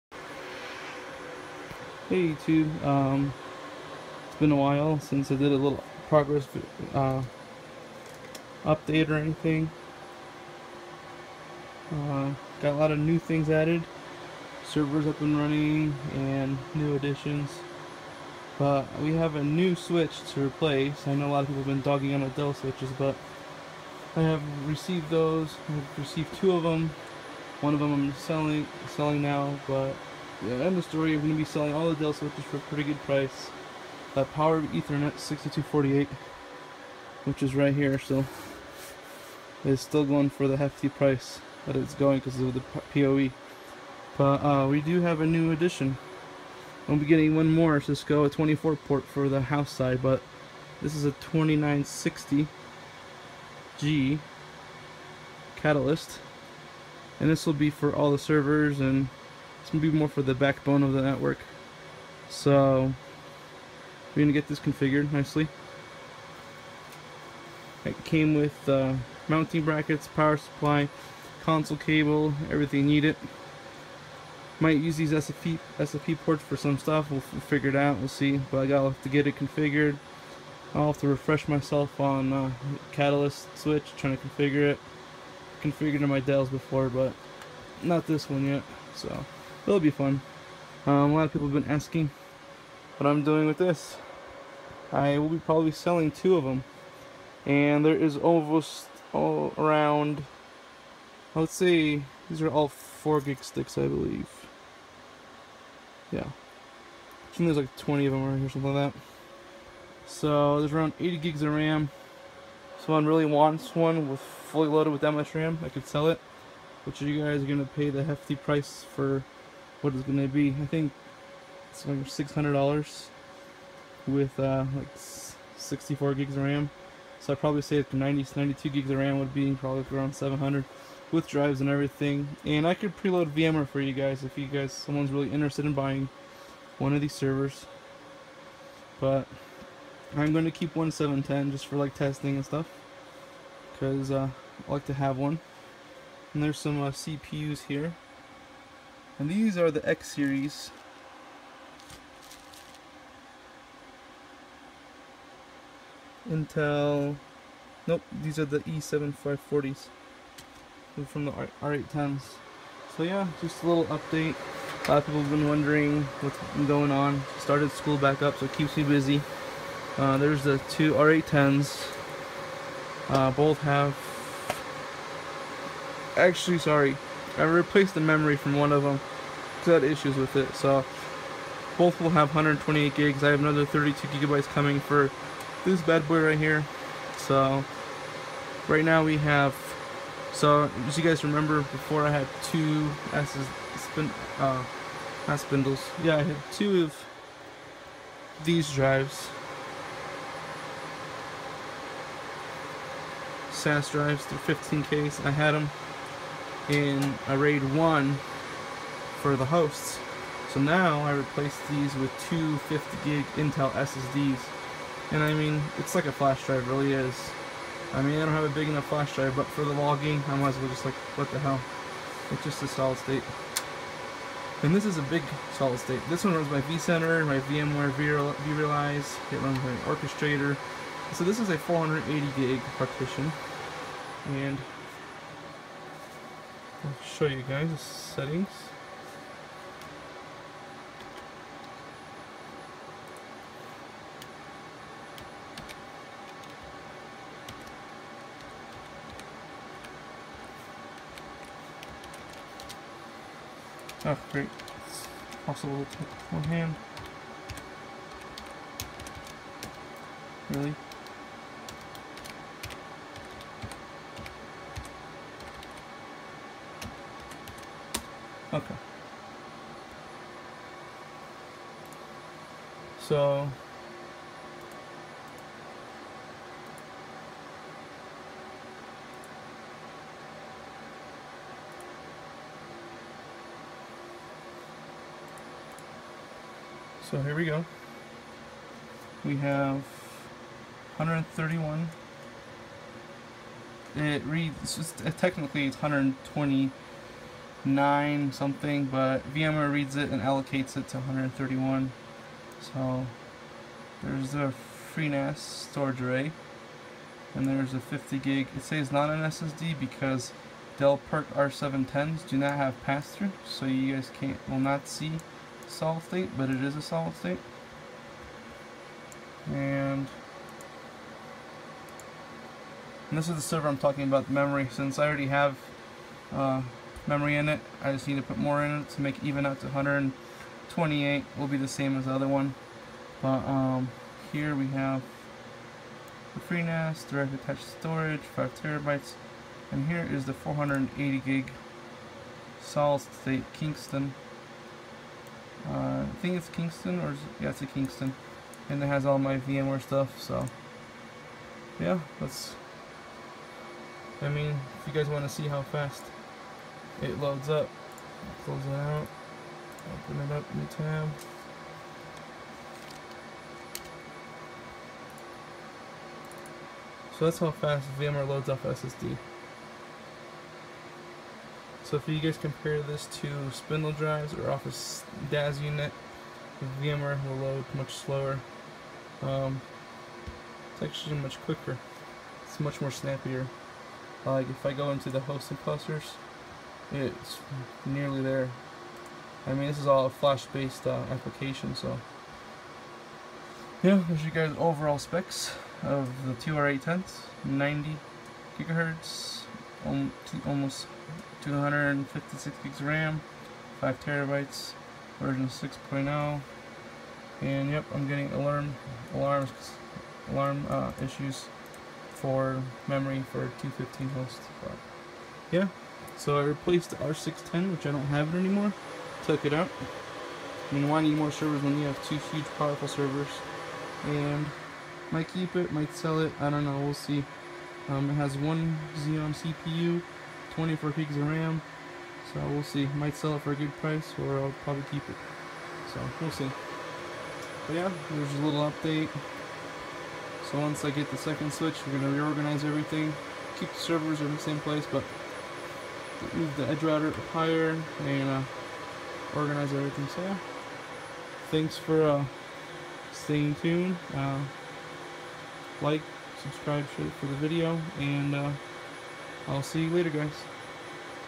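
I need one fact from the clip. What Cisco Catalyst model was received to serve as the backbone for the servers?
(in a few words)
2960G.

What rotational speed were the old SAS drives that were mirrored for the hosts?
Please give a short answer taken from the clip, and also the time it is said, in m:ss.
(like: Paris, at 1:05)
15K, at 3:24.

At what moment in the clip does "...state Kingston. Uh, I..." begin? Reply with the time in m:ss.
5:43.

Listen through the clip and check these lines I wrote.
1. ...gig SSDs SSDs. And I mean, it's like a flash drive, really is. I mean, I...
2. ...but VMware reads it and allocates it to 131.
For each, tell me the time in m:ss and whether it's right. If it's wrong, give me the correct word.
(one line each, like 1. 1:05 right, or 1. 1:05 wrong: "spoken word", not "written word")
1. 3:33 wrong: "Intel", not "SSDs"
2. 4:58 right.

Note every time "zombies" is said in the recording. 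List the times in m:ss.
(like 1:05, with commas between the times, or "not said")
not said.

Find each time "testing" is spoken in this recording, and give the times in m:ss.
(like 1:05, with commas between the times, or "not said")
2:21.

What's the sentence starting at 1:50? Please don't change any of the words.
So there's around 80 gigs of RAM.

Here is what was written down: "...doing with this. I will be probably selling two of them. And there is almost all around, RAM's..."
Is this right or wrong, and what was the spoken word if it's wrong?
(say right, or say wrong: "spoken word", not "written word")
wrong: "Let", not "RAM".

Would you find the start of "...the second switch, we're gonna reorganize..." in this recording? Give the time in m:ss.
7:21.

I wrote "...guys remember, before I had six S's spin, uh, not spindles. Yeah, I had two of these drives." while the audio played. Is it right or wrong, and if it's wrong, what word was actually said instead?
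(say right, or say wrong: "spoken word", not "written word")
wrong: "two", not "six".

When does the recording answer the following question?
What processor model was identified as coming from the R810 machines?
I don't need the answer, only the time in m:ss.
2:38.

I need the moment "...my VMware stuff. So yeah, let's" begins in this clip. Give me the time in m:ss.
5:49.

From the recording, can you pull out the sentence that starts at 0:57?
And this will be for all the servers and it's going to be more for the backbone of the network.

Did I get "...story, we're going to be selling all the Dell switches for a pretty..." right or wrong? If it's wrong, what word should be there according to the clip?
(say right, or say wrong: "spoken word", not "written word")
right.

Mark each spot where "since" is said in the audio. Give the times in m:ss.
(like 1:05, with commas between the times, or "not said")
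0:04, 5:24.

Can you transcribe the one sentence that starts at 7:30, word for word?
So yeah, thanks for uh, staying tuned.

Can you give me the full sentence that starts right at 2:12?
And I could preload VMware for you guys if you guys someone's really interested in buying one of these servers.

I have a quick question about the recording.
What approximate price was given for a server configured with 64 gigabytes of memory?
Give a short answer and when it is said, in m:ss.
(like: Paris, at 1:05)
$600, at 2:02.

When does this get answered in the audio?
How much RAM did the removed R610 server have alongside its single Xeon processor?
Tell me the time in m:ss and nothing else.
7:10.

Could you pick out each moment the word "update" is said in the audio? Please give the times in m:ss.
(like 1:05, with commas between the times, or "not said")
0:08, 2:43, 7:18.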